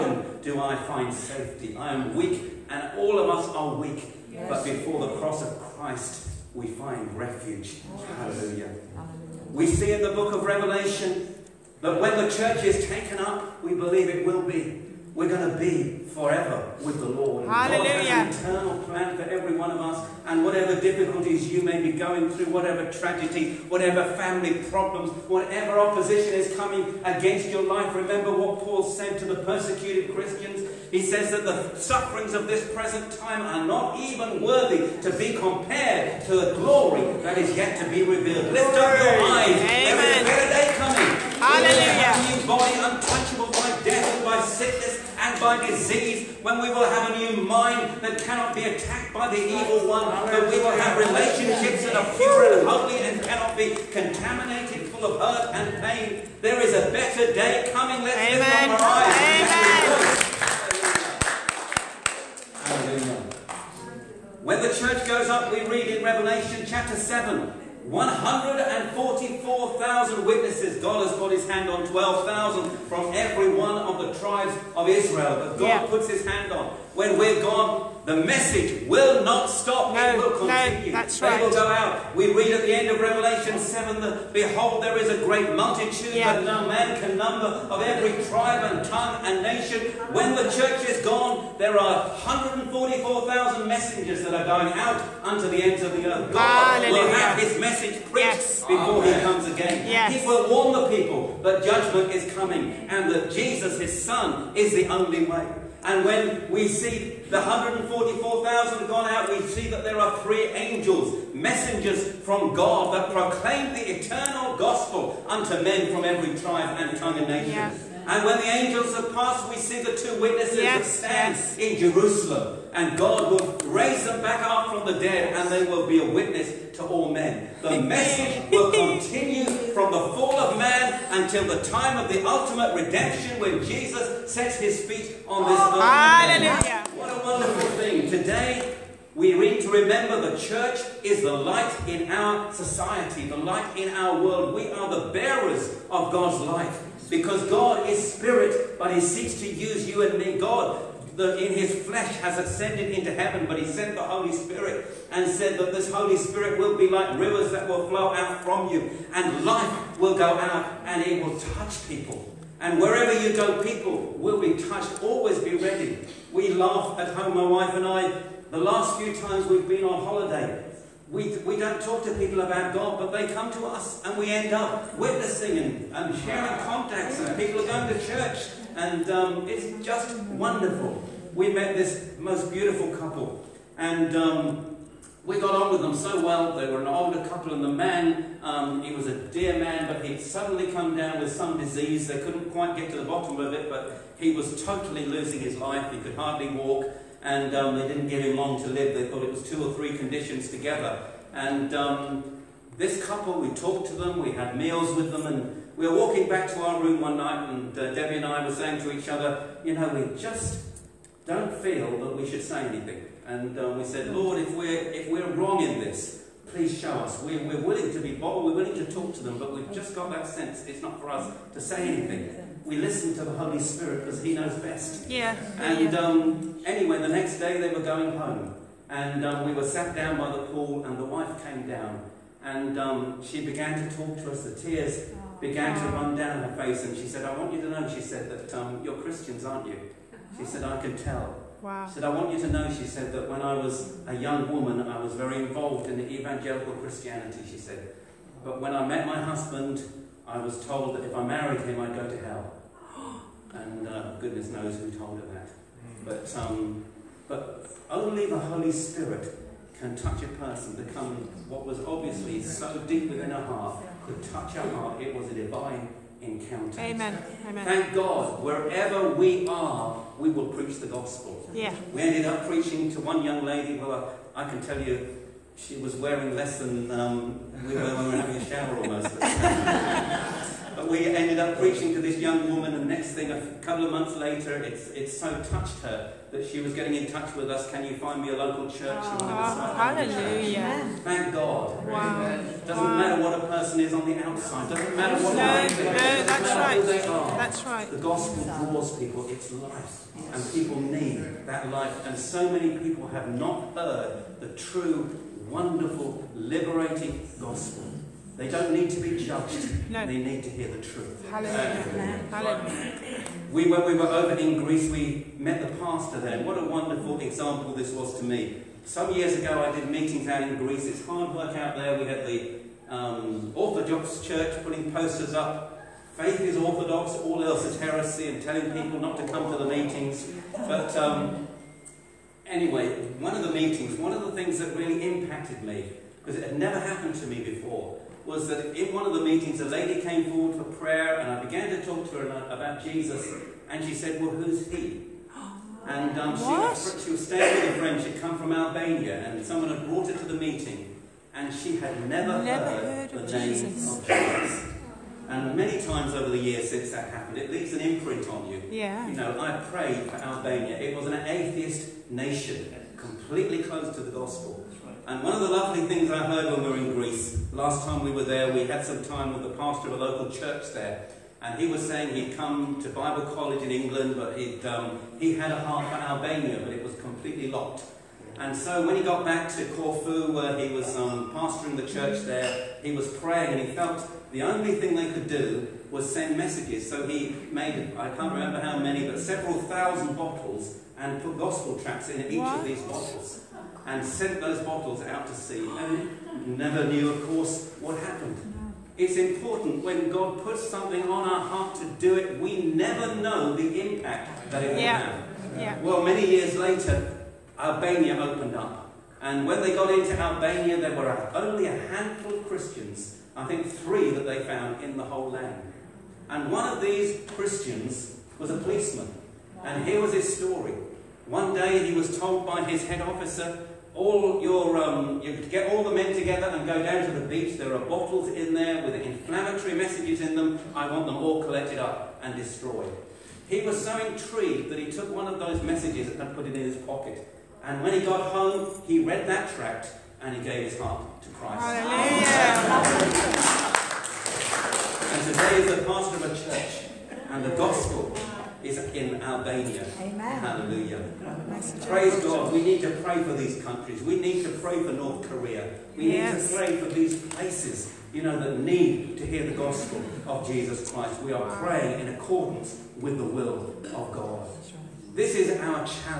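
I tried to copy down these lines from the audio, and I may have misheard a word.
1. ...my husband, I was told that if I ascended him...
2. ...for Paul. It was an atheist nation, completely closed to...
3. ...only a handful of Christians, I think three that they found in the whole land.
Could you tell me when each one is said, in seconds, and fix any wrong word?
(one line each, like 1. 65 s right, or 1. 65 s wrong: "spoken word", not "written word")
1. 249 s wrong: "married", not "ascended"
2. 360 s wrong: "Albania", not "Paul"
3. 411 s right.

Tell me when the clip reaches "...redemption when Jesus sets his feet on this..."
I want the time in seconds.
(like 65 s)
132 s.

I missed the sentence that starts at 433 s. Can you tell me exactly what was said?
He was so intrigued that he took one of those messages and put it in his pocket.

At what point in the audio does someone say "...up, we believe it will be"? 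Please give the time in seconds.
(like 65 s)
13 s.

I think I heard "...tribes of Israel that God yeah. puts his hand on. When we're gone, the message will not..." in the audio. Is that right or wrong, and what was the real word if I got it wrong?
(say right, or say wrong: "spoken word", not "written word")
right.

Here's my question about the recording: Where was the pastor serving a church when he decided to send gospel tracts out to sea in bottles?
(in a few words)
Corfu.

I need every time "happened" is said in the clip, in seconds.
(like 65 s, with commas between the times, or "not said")
336 s, 357 s, 397 s.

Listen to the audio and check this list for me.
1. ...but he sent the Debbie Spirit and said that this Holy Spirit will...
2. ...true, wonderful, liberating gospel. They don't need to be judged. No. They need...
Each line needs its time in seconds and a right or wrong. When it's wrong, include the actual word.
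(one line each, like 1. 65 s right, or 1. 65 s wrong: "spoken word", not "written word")
1. 153 s wrong: "Holy", not "Debbie"
2. 304 s right.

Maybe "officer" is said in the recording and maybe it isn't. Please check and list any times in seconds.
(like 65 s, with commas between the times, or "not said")
422 s.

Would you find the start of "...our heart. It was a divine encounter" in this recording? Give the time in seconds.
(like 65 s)
264 s.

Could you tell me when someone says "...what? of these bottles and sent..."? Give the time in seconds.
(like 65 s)
392 s.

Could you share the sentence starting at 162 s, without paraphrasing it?
And wherever you go, people will be touched.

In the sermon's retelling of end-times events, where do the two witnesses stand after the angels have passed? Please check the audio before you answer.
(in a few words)
Jerusalem.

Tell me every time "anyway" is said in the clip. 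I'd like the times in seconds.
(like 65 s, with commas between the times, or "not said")
226 s, 332 s.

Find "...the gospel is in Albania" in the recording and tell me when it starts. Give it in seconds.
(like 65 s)
447 s.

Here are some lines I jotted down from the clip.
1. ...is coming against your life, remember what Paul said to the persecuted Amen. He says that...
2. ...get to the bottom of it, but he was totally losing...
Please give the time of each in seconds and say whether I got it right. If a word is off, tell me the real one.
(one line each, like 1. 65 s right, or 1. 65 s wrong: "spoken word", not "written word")
1. 26 s wrong: "Christians", not "Amen"
2. 192 s right.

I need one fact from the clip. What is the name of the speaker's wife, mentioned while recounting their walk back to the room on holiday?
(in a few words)
Debbie.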